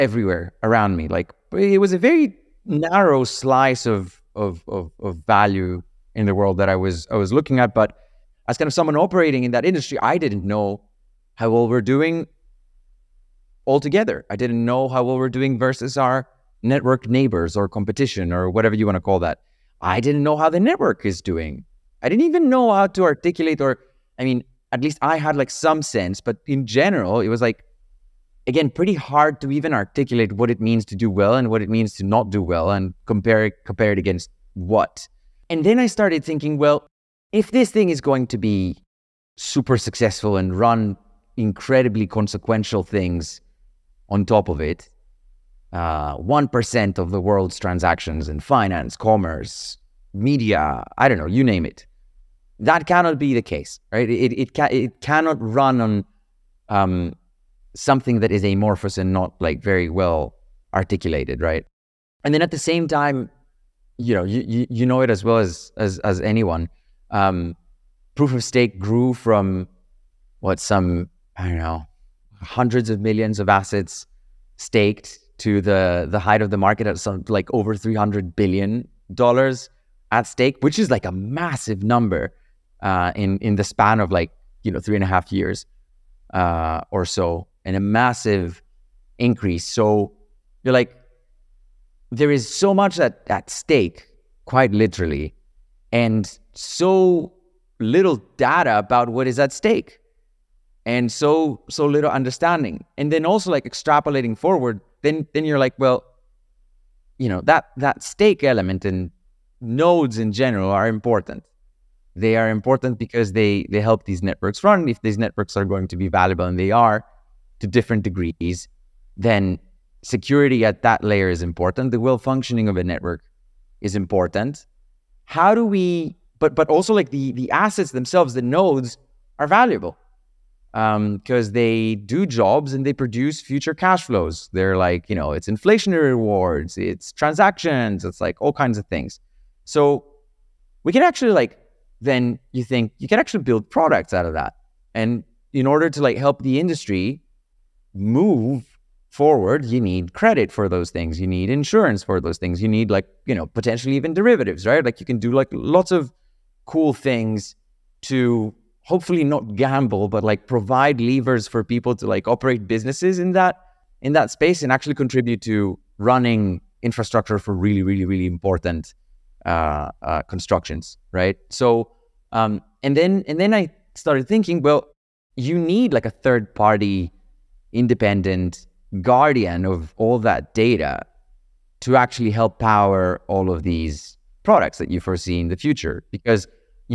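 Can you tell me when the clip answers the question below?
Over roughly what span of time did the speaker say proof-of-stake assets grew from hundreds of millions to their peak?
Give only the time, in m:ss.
1:24.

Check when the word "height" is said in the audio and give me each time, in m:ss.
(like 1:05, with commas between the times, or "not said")
1:16.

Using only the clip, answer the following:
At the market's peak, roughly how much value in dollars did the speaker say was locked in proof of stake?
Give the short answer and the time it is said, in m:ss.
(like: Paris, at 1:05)
over 300 billion dollars, at 1:17.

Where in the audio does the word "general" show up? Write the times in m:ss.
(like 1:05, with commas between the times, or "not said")
0:26, 1:50.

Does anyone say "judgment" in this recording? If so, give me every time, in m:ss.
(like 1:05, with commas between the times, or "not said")
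not said.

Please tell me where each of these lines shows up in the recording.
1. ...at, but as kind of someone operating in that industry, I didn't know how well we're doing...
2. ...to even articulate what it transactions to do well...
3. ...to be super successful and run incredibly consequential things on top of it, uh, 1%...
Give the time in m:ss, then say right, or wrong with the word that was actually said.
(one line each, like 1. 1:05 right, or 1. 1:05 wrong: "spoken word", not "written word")
1. 0:07 right
2. 0:29 wrong: "means", not "transactions"
3. 0:38 right.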